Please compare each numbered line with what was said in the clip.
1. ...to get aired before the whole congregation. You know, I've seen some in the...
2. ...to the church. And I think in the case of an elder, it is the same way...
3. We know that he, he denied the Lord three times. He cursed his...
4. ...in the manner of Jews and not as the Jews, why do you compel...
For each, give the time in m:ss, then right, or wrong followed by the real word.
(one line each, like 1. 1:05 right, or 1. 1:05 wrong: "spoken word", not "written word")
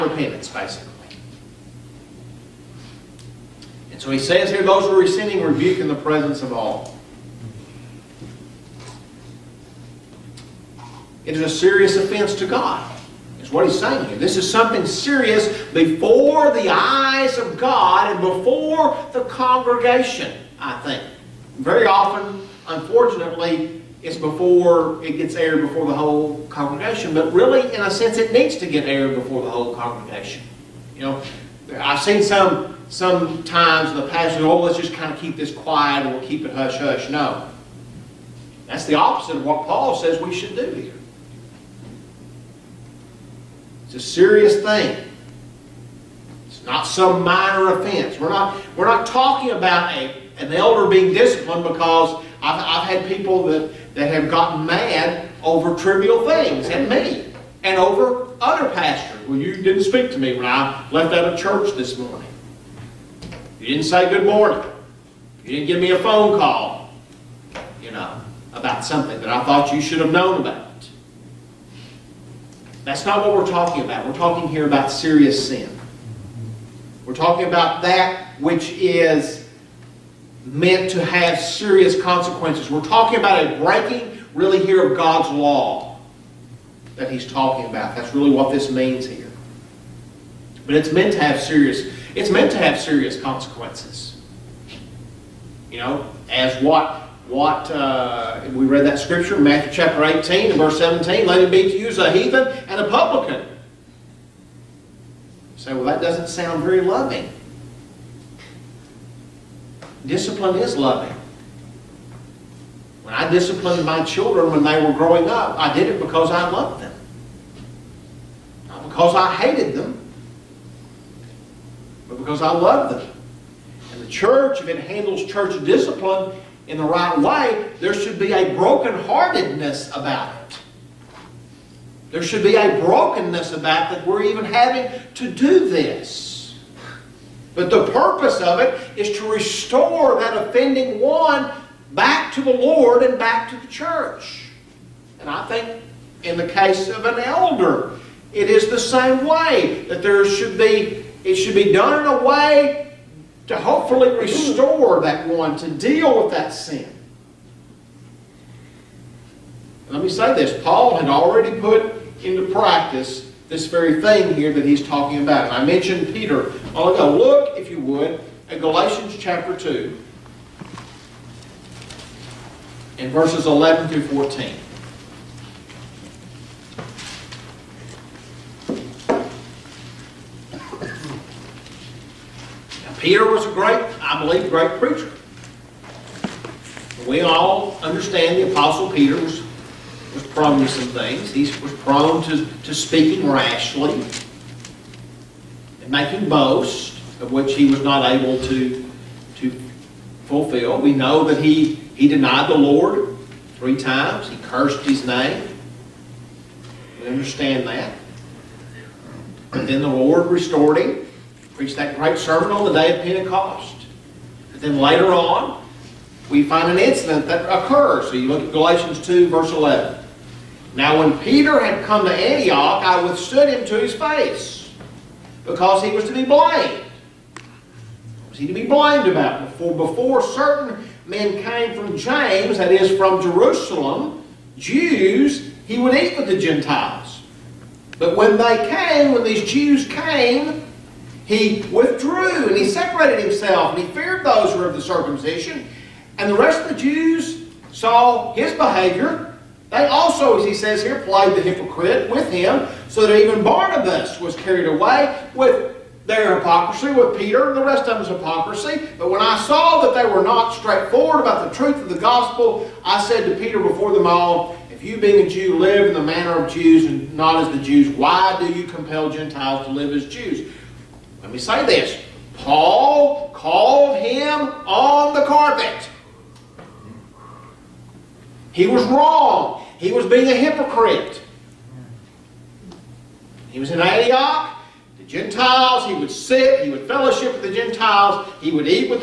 1. 0:28 right
2. 2:23 right
3. 3:20 right
4. 4:25 right.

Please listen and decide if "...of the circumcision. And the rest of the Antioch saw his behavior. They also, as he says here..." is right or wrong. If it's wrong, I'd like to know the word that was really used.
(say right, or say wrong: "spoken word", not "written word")
wrong: "Jews", not "Antioch".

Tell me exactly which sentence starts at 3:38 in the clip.
So you look at Galatians 2, verse 11.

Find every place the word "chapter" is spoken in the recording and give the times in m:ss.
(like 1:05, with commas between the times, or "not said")
1:39, 2:49.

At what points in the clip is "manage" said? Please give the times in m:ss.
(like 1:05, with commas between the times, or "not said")
not said.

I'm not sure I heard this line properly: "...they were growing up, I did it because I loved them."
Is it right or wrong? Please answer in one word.
right.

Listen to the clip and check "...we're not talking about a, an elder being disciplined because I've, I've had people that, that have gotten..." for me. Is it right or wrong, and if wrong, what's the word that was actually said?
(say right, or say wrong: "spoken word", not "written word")
right.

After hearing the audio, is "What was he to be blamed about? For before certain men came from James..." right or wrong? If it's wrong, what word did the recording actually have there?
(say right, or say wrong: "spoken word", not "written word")
right.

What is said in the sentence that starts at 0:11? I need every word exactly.
It is a serious offense to God is what he's saying here.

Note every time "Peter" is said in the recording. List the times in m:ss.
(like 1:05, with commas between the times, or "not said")
2:46, 3:02, 3:08, 3:41, 4:17, 4:23.